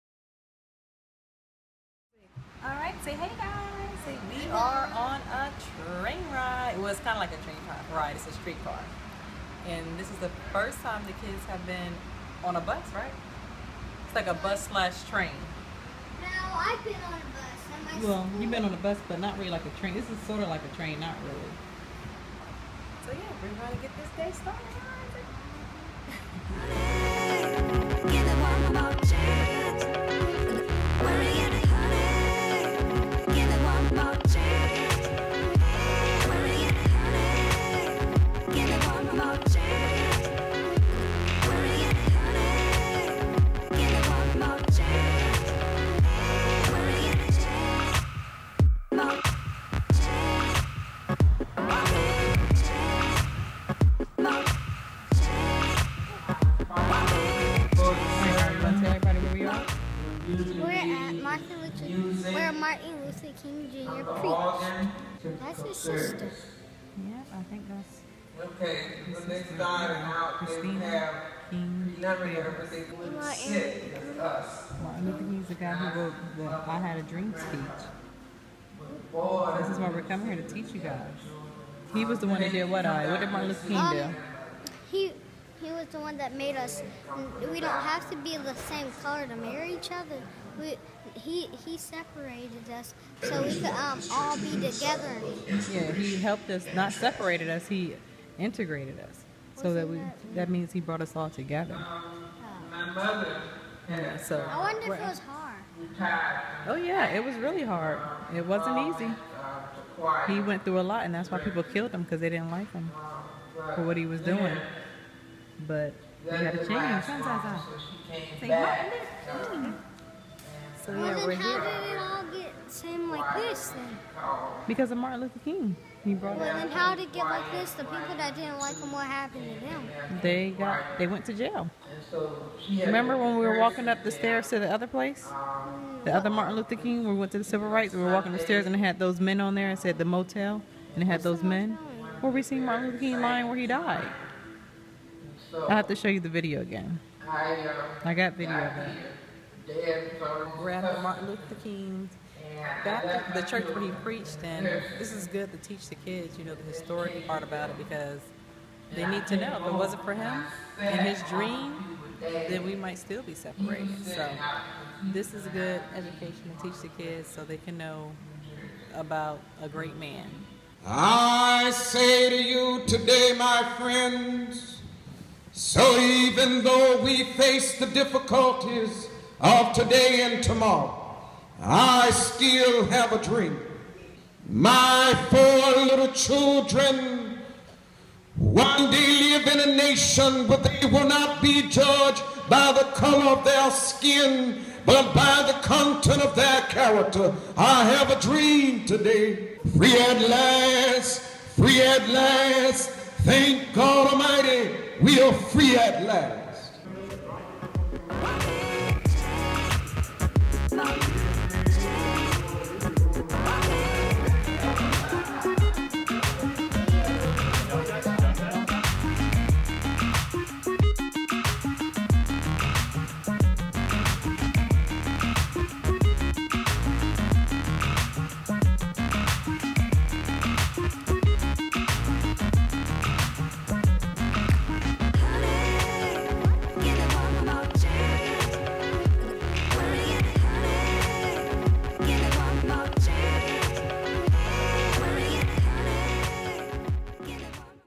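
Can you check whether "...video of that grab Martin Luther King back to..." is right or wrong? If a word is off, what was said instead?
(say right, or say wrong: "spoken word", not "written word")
right.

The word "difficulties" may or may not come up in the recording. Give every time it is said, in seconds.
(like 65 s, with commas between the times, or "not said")
177 s.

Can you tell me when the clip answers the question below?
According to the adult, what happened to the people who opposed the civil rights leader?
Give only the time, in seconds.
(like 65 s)
130 s.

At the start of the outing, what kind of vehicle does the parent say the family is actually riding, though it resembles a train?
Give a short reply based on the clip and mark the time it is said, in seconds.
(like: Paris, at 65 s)
streetcar, at 8 s.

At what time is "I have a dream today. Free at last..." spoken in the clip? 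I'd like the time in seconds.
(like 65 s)
197 s.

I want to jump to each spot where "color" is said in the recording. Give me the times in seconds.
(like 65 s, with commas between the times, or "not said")
89 s, 192 s.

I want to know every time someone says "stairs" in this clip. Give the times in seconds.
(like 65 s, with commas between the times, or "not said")
134 s, 138 s.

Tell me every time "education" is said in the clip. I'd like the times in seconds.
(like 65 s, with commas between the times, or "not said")
165 s.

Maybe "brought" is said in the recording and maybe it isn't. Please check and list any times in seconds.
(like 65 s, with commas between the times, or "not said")
100 s, 126 s.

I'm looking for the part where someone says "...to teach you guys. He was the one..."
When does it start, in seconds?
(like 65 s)
80 s.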